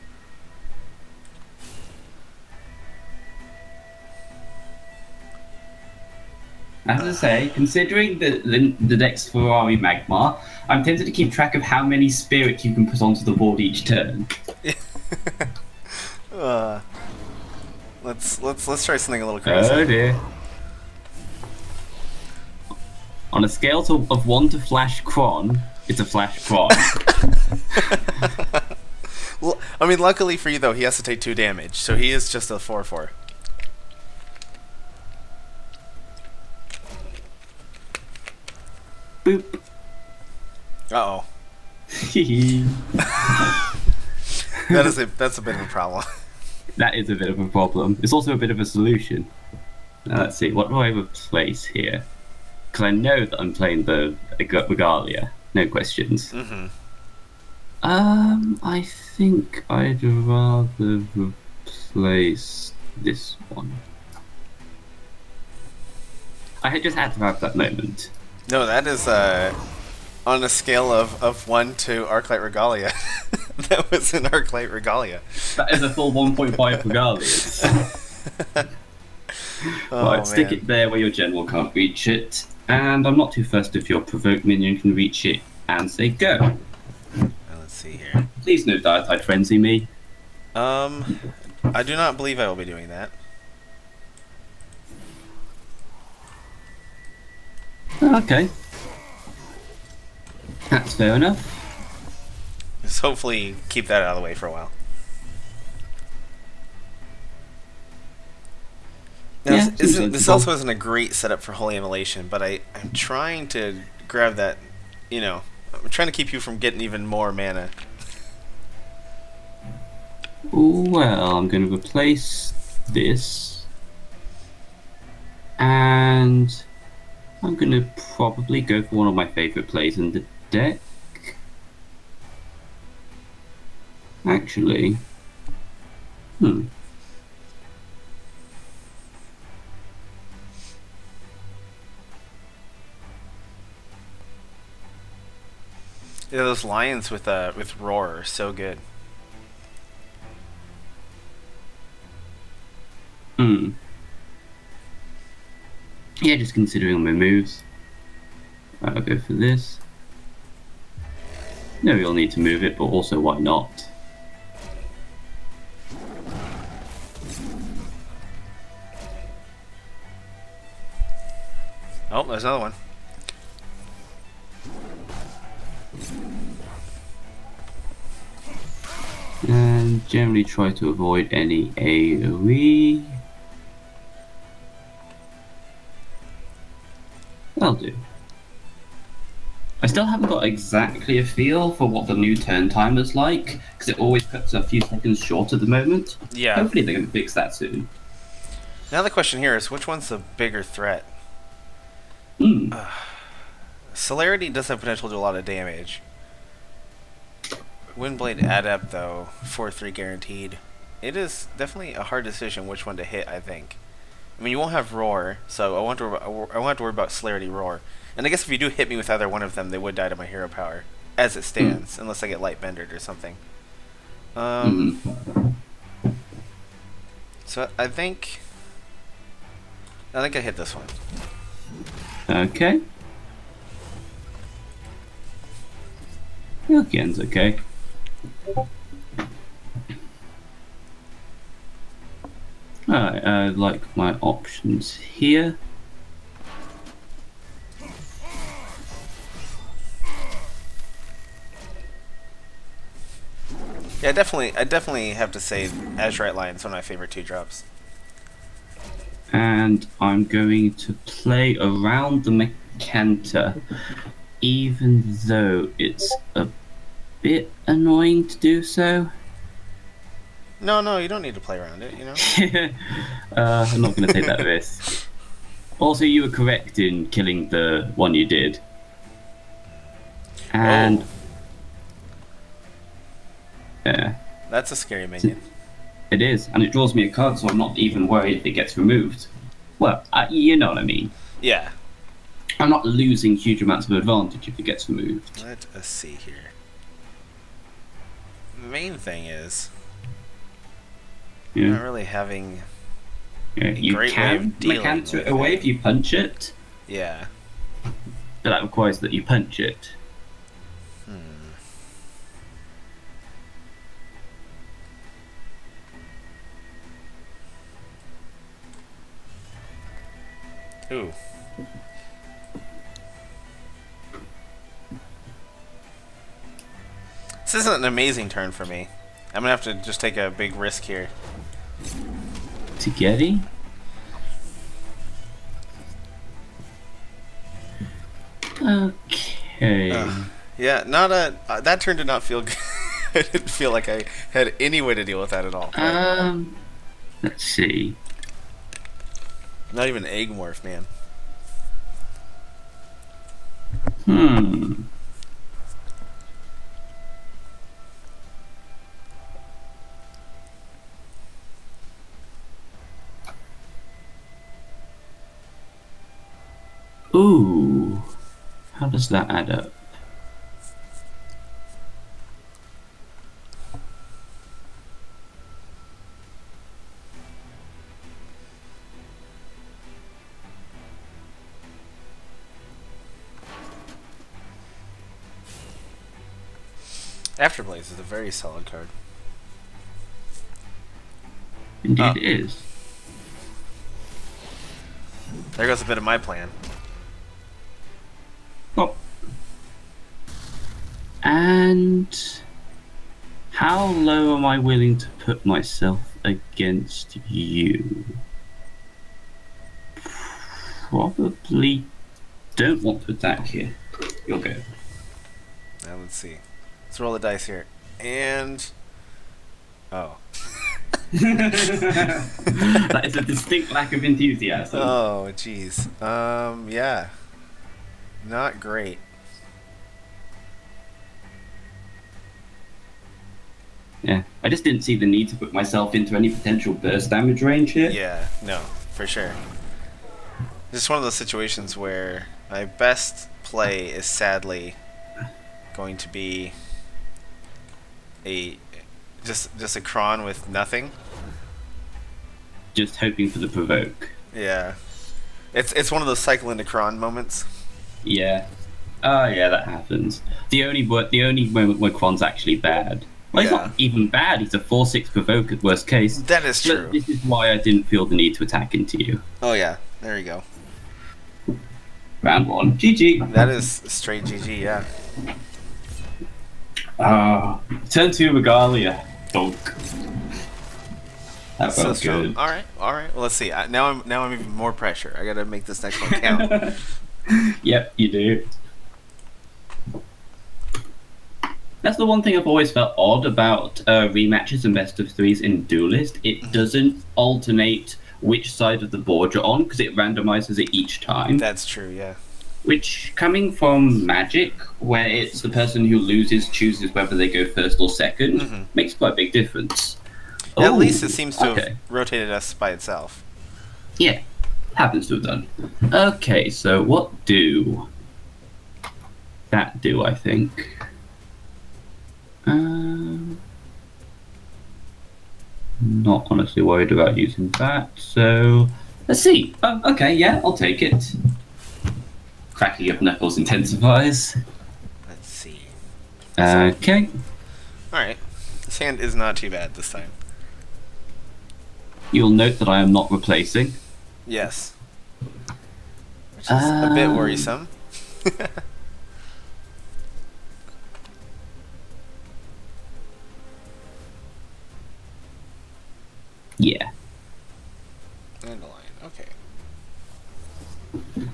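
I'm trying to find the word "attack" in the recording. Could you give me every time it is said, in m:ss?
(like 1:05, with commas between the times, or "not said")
6:53, 7:48.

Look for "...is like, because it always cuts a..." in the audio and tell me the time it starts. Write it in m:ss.
3:12.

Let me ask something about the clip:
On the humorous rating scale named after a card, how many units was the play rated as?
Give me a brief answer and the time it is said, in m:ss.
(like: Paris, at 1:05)
1.5, at 1:15.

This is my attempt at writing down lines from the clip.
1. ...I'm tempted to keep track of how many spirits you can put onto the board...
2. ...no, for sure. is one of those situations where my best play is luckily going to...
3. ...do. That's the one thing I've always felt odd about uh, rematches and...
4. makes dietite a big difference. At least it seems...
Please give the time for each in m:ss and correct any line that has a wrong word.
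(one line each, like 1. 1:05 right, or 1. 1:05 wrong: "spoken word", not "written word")
1. 0:10 right
2. 7:18 wrong: "sadly", not "luckily"
3. 8:08 right
4. 8:28 wrong: "quite", not "dietite".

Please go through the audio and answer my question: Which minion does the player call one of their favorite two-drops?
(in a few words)
Azurite Lion.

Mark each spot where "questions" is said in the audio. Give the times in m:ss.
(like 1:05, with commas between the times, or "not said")
0:55, 3:19.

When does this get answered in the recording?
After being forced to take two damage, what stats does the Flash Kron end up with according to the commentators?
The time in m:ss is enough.
0:32.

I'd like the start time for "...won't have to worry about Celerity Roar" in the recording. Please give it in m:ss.
3:36.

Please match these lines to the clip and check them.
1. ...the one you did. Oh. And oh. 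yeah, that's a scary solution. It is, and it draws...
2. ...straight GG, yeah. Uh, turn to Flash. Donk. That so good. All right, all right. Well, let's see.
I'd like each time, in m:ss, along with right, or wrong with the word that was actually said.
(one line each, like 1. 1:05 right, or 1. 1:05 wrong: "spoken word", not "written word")
1. 4:37 wrong: "minion", not "solution"
2. 7:53 wrong: "Regalia", not "Flash".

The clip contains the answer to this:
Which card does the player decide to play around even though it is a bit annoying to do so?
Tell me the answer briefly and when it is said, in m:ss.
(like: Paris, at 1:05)
Mecanta, at 4:22.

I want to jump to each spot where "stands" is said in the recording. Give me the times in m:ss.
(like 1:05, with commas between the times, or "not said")
3:41.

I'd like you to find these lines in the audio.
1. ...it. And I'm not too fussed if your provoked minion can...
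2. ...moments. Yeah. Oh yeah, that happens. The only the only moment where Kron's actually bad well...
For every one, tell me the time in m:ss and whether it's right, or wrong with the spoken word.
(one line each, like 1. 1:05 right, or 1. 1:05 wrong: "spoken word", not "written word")
1. 1:22 right
2. 7:36 right.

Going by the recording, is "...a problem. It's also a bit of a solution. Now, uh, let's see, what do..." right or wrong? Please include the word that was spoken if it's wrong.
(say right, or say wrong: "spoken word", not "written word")
right.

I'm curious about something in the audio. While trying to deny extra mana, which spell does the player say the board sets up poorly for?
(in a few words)
Holy Immolation.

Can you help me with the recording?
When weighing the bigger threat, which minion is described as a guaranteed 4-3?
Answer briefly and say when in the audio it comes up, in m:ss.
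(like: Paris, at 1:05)
Windblade Adept, at 3:27.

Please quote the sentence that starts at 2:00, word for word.
Well, I'm going to replace this and I'm going to probably go for one of my favourite plays in the deck.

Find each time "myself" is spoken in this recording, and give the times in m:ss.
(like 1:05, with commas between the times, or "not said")
6:45, 7:15.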